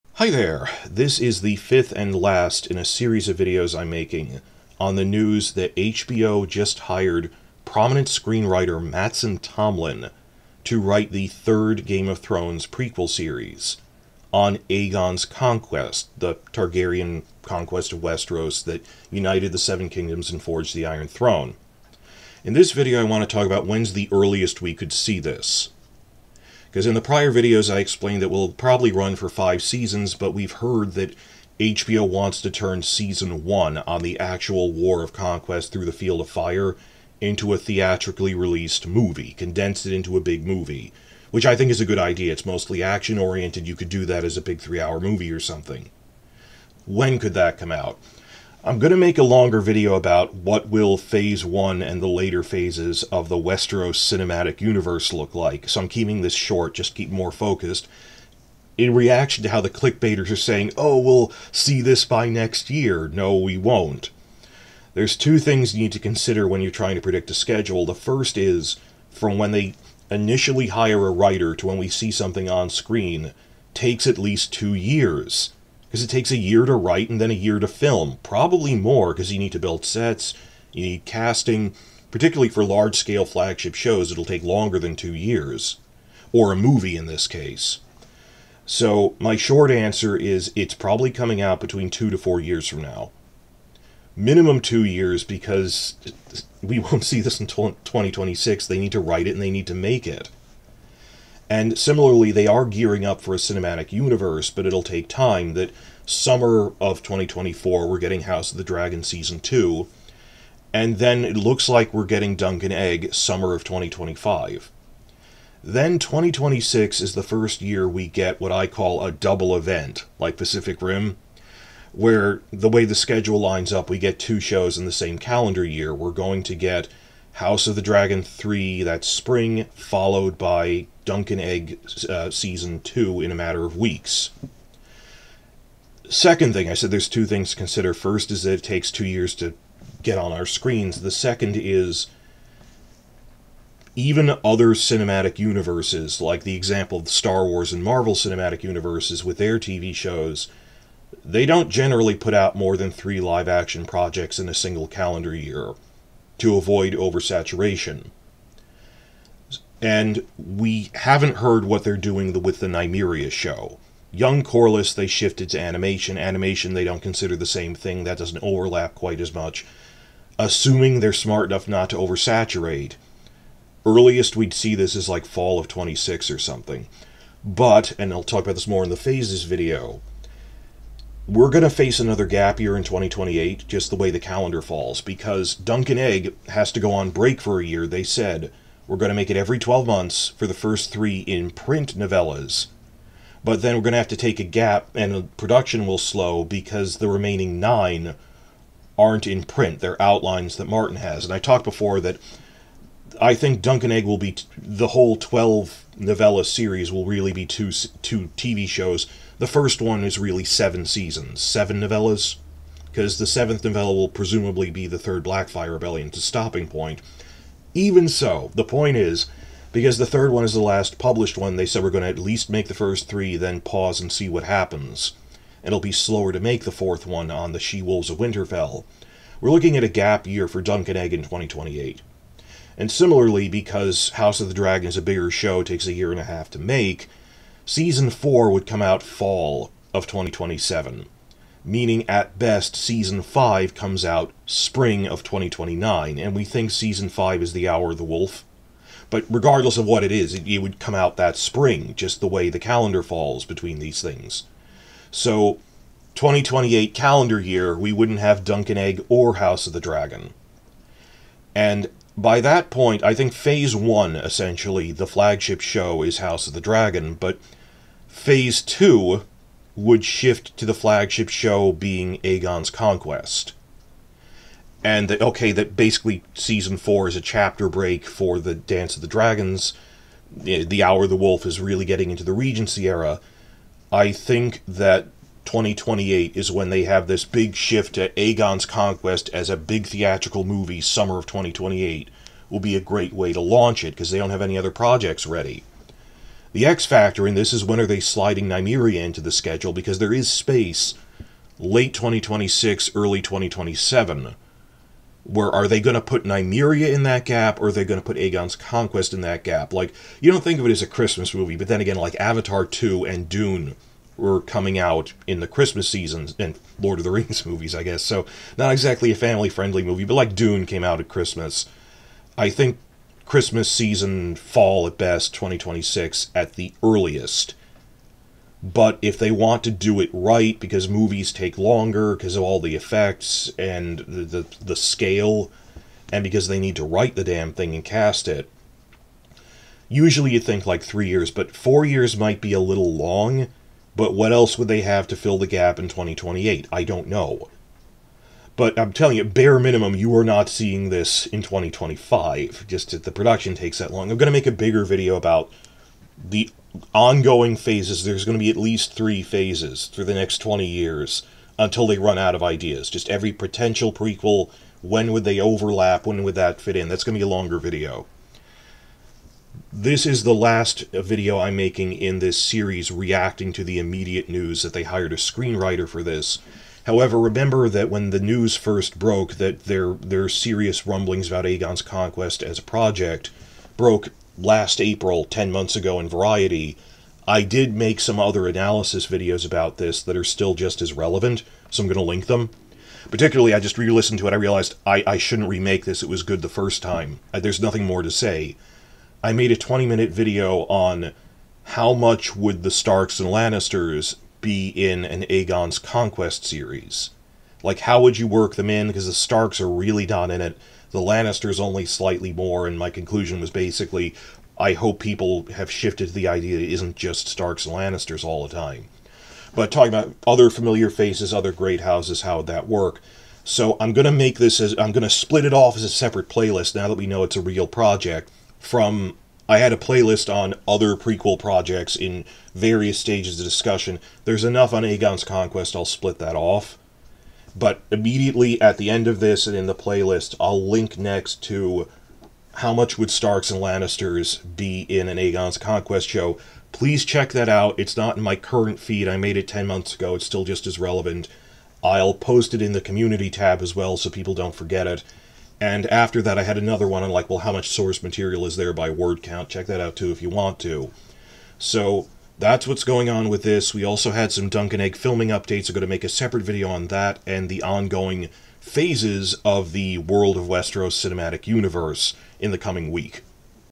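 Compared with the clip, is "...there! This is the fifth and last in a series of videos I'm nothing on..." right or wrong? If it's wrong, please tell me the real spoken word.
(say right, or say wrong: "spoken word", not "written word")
wrong: "making", not "nothing".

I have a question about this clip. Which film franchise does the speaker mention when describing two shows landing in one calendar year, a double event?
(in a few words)
Pacific Rim.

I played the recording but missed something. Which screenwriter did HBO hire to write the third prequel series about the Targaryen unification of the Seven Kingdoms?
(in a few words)
Mattson Tomlin.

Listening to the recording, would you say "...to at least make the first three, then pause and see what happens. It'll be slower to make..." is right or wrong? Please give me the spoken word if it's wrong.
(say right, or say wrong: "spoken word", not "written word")
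right.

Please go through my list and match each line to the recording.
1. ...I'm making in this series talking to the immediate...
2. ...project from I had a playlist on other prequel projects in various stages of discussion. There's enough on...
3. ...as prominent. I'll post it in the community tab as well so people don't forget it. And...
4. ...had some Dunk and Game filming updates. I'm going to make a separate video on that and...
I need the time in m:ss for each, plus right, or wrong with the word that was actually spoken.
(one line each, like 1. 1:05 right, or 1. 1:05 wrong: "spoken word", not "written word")
1. 6:11 wrong: "reacting", not "talking"
2. 7:07 right
3. 7:30 wrong: "relevant", not "prominent"
4. 7:44 wrong: "Egg", not "Game".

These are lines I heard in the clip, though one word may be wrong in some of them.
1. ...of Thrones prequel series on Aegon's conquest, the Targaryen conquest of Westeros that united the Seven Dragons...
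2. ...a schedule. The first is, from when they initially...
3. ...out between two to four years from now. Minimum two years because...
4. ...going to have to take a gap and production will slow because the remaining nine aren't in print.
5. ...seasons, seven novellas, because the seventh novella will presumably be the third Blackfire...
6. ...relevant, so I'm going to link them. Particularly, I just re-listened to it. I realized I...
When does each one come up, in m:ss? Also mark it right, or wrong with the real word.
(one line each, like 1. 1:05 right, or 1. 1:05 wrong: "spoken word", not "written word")
1. 0:12 wrong: "Kingdoms", not "Dragons"
2. 1:07 right
3. 1:31 right
4. 3:13 right
5. 3:30 right
6. 6:30 right.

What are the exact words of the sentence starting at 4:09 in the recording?
But regardless of what it is, it, it would come out that spring, just the way the calendar falls between these things.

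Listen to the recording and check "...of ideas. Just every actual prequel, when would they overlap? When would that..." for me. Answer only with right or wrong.
wrong.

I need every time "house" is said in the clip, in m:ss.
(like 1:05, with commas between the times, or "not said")
1:48, 2:07, 3:54, 4:19, 4:26, 7:01.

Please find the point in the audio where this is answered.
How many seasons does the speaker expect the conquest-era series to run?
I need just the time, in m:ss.
0:29.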